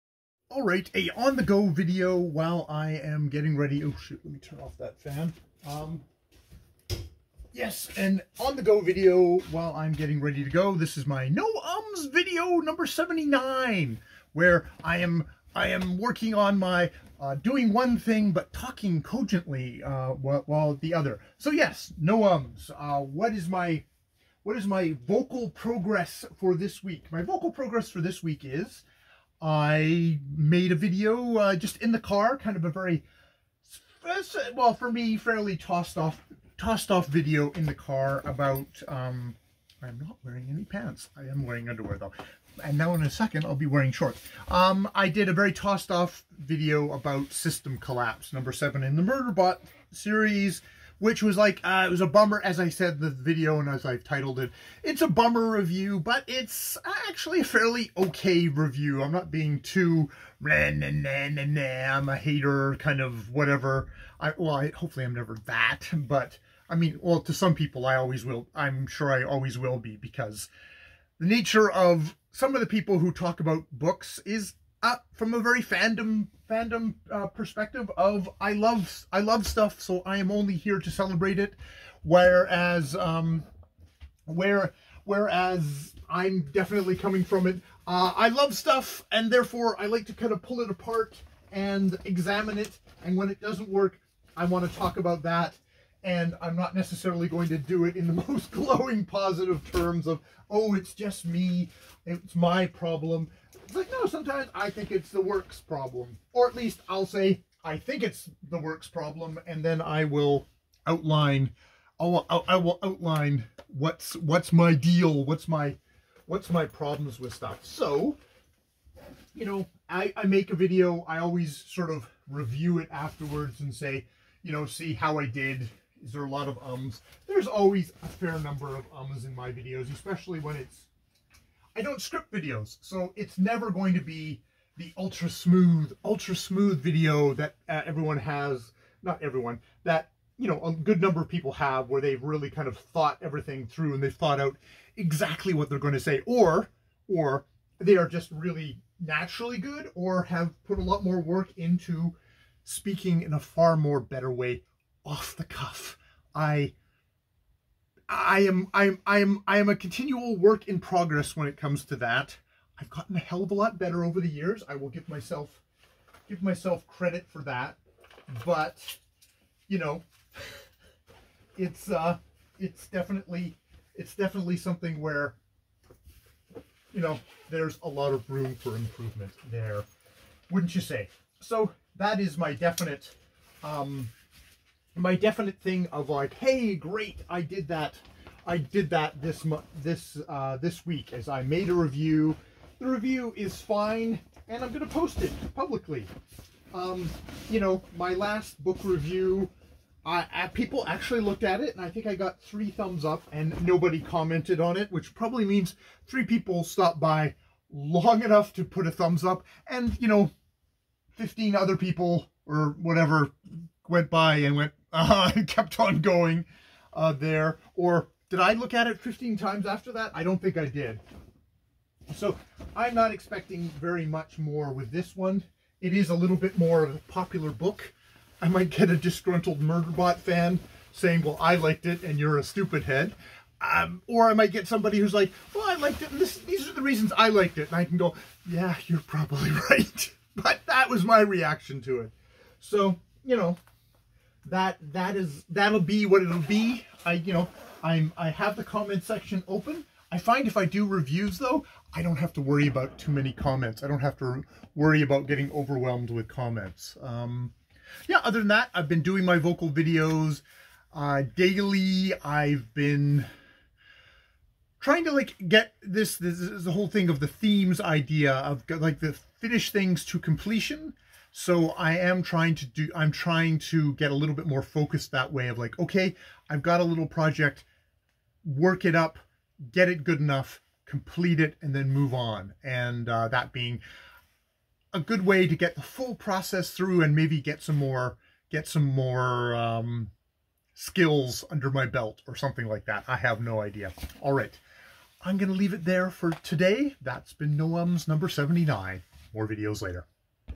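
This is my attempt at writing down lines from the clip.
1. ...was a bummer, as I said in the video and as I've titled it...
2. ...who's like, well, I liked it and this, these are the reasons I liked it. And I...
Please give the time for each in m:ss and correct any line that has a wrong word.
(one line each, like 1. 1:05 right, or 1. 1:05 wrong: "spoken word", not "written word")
1. 0:51 right
2. 3:54 right.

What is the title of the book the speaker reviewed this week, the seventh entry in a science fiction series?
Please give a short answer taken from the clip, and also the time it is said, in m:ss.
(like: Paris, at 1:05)
System Collapse, at 0:47.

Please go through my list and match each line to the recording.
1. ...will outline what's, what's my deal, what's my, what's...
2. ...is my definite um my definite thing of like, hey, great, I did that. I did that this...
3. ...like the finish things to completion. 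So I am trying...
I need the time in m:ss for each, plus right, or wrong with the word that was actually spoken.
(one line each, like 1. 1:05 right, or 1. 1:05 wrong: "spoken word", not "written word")
1. 1:52 right
2. 3:02 right
3. 4:28 right.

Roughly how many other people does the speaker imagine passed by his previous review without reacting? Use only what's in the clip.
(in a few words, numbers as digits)
15.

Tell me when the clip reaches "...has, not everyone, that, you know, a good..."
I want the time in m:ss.
2:18.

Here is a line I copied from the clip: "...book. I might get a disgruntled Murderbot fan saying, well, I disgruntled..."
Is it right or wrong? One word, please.
wrong.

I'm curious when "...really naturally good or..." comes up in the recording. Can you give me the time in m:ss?
2:28.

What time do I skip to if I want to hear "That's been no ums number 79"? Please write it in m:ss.
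4:57.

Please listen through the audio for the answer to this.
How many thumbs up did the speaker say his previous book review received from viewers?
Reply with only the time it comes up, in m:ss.
3:22.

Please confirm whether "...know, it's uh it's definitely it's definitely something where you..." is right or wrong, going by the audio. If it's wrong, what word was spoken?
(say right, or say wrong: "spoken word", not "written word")
right.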